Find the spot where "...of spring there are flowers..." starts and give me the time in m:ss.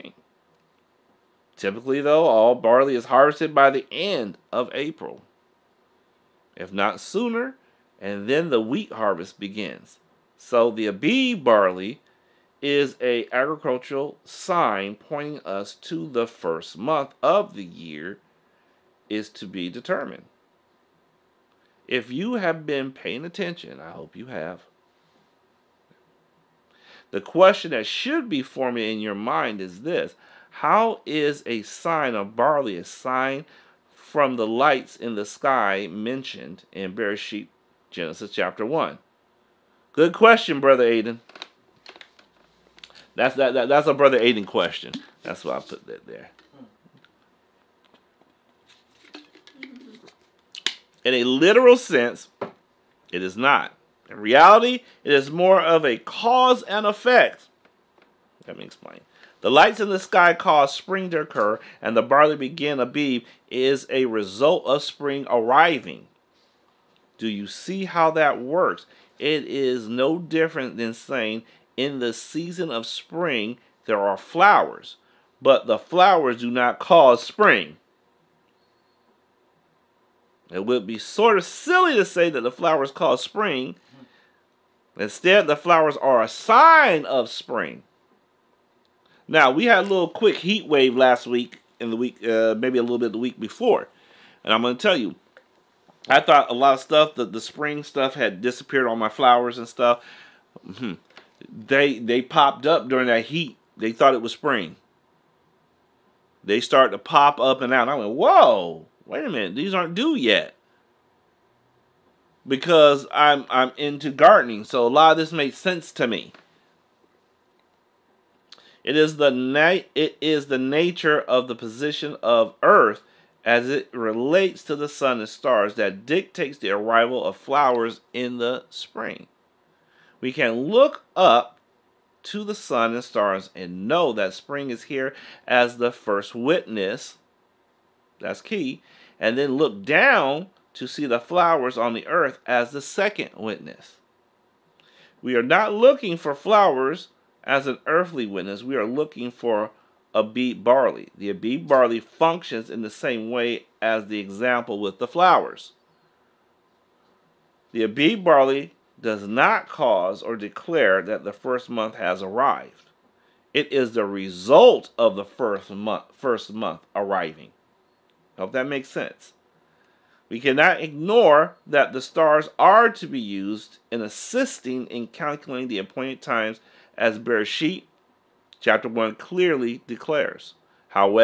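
1:12.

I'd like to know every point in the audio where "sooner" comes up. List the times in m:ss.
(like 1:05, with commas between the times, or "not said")
0:07.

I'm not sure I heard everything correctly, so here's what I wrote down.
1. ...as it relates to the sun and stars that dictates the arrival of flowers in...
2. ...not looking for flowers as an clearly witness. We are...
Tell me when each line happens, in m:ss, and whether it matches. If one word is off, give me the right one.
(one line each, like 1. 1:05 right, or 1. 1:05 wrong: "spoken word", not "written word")
1. 2:03 right
2. 2:25 wrong: "earthly", not "clearly".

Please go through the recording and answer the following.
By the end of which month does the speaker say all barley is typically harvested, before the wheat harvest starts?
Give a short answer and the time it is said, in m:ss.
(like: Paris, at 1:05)
April, at 0:04.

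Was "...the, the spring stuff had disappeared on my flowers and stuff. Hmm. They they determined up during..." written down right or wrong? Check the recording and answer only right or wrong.
wrong.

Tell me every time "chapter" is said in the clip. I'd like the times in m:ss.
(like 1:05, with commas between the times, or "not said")
0:38, 2:58.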